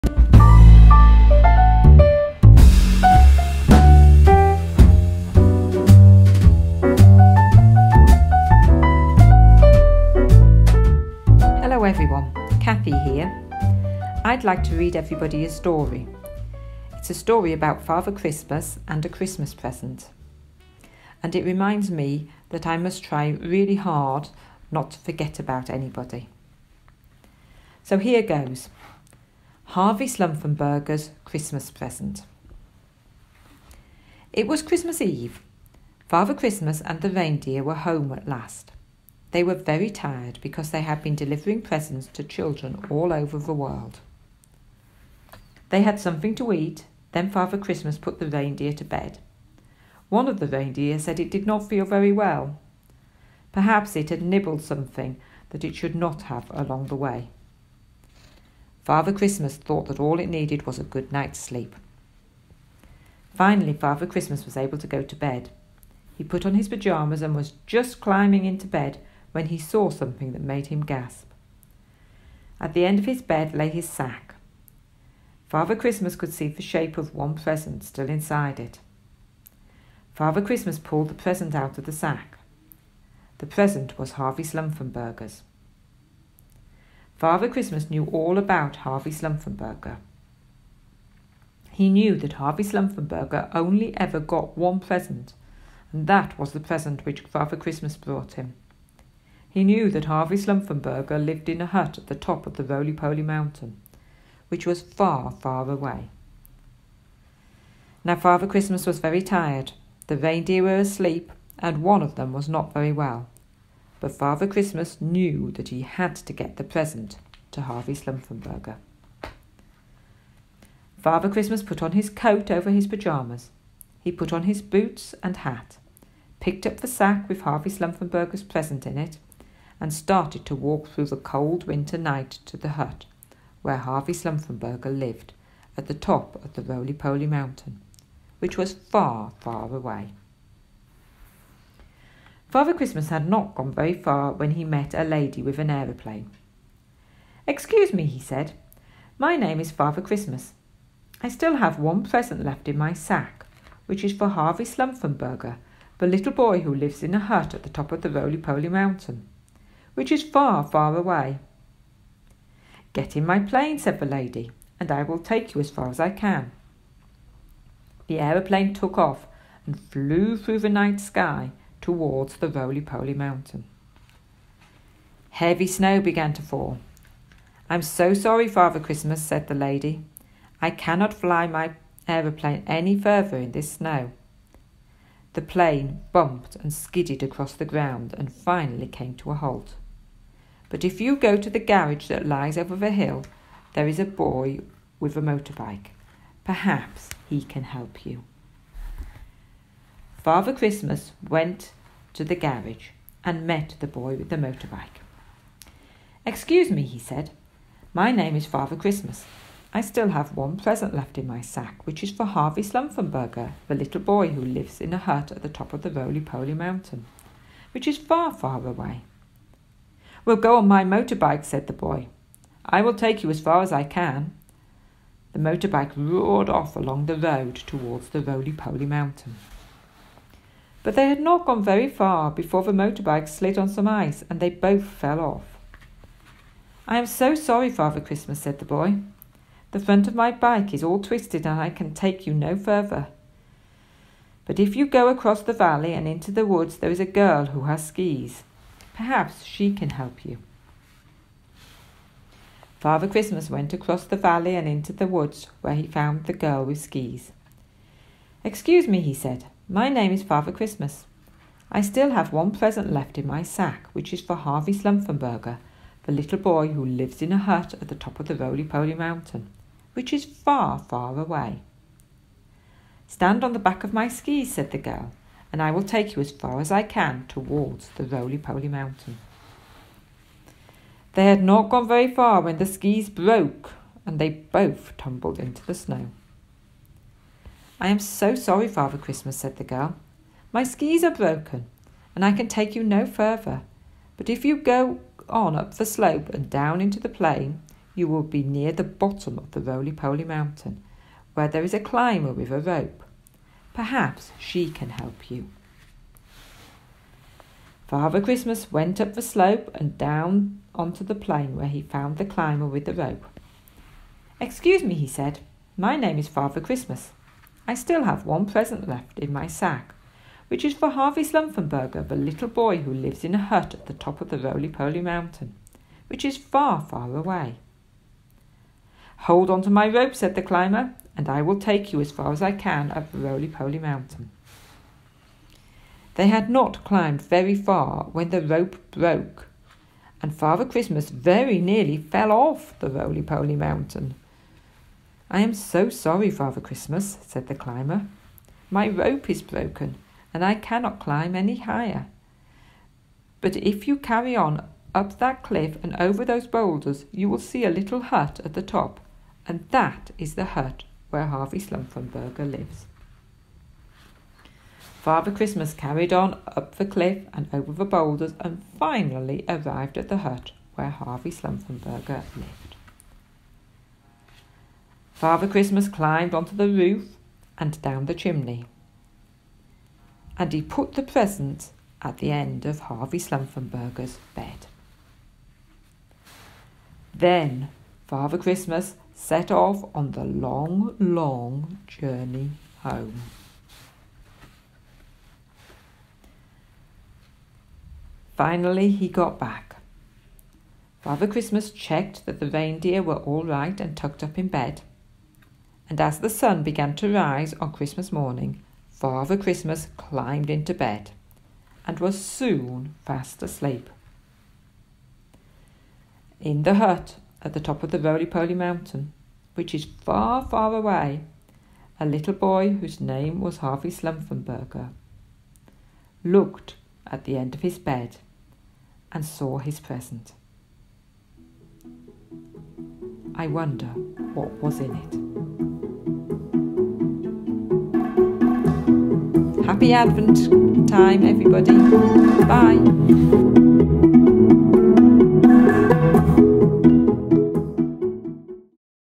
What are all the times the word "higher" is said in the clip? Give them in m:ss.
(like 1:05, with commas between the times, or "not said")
5:51.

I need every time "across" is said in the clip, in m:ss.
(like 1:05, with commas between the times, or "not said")
3:07, 4:05, 4:13.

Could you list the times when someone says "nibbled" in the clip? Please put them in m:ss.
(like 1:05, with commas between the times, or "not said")
0:54.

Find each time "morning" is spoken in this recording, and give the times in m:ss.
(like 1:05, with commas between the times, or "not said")
6:48.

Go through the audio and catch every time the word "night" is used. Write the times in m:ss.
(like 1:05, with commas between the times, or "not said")
1:01, 2:11, 2:50.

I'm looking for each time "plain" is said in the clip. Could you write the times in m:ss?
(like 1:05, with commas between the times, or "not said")
4:57, 5:11.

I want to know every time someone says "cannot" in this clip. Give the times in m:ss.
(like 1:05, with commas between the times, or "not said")
3:00, 5:50.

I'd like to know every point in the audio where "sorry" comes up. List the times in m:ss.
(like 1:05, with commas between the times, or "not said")
2:58, 3:57, 4:48, 5:45.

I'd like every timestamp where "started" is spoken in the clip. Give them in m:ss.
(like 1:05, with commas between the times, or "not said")
2:09.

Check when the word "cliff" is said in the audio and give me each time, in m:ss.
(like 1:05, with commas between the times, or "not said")
5:55, 6:06.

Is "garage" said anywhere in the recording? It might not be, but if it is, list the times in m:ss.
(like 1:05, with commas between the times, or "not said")
3:11, 3:22.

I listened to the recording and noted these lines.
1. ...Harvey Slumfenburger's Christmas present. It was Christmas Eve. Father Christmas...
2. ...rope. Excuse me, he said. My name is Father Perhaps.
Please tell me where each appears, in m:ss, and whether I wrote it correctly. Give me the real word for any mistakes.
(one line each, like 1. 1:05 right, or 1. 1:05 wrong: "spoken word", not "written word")
1. 0:29 right
2. 5:12 wrong: "Christmas", not "Perhaps".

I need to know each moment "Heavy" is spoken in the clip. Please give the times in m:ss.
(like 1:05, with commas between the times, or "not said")
2:55.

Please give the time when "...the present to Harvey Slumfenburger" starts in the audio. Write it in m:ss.
1:56.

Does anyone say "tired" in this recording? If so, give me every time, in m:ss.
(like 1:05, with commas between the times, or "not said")
0:39, 1:49.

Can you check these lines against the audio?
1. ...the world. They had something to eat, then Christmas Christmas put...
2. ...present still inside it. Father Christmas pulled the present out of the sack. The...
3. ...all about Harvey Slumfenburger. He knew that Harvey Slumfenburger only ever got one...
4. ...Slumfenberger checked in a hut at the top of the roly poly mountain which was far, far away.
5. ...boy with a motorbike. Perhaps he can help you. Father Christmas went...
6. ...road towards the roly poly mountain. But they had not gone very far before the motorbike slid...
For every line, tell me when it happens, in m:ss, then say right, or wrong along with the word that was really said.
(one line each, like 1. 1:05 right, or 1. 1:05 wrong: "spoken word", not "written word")
1. 0:43 wrong: "Father", not "Christmas"
2. 1:17 right
3. 1:28 right
4. 1:40 wrong: "lived", not "checked"
5. 3:14 right
6. 3:47 right.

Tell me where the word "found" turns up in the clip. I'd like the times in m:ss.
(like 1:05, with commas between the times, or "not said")
4:15, 5:11.